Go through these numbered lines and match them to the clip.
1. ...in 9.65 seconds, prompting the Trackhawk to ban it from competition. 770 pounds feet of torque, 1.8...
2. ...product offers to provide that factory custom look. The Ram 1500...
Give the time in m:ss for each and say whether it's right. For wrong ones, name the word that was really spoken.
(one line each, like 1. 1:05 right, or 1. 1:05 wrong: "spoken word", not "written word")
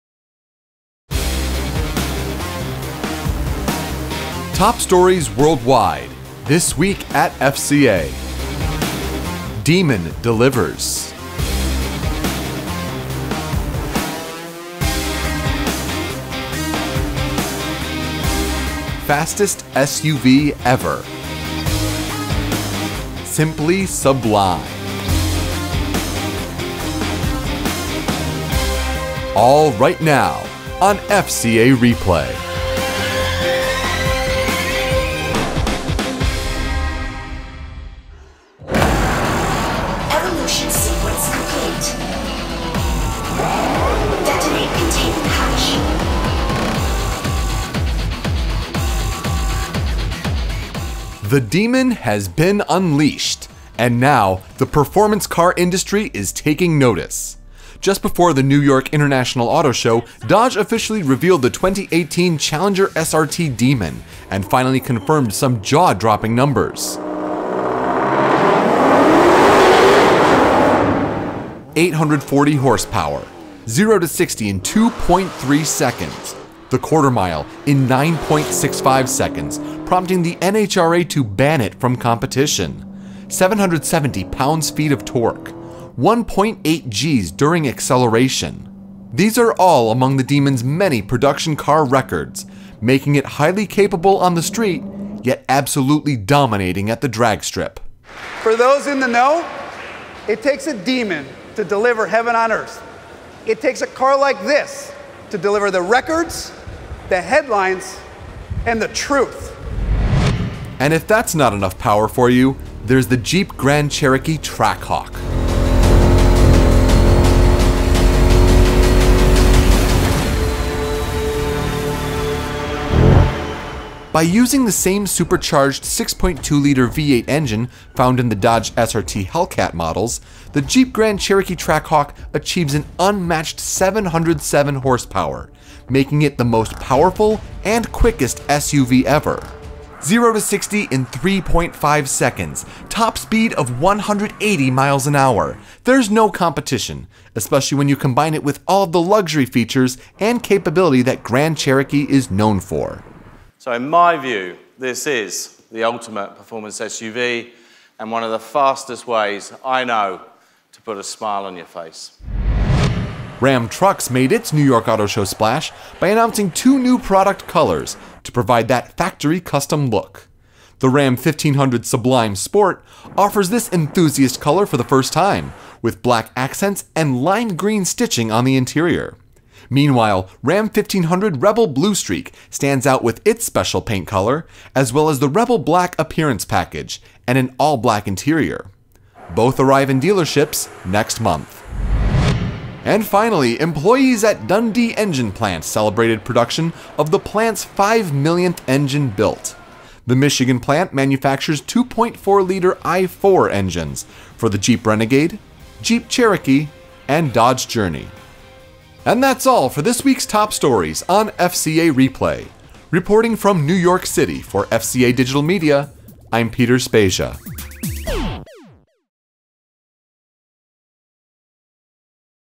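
1. 1:17 wrong: "NHRA", not "Trackhawk"
2. 2:46 wrong: "colors", not "offers".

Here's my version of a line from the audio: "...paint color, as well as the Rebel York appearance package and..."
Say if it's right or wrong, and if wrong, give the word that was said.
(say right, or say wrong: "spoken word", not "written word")
wrong: "Black", not "York".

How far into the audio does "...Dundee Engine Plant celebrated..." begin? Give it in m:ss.
3:14.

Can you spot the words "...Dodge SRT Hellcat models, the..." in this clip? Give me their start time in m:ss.
2:08.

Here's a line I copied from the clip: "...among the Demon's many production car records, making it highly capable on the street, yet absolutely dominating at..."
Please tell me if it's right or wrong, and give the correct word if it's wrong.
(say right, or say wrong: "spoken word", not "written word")
right.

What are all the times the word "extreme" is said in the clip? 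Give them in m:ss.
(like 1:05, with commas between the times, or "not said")
not said.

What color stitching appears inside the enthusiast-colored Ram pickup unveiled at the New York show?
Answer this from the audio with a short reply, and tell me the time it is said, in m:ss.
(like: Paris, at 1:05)
lime green, at 2:57.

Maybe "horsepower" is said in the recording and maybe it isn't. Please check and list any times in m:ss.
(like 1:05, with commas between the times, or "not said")
1:12, 2:14.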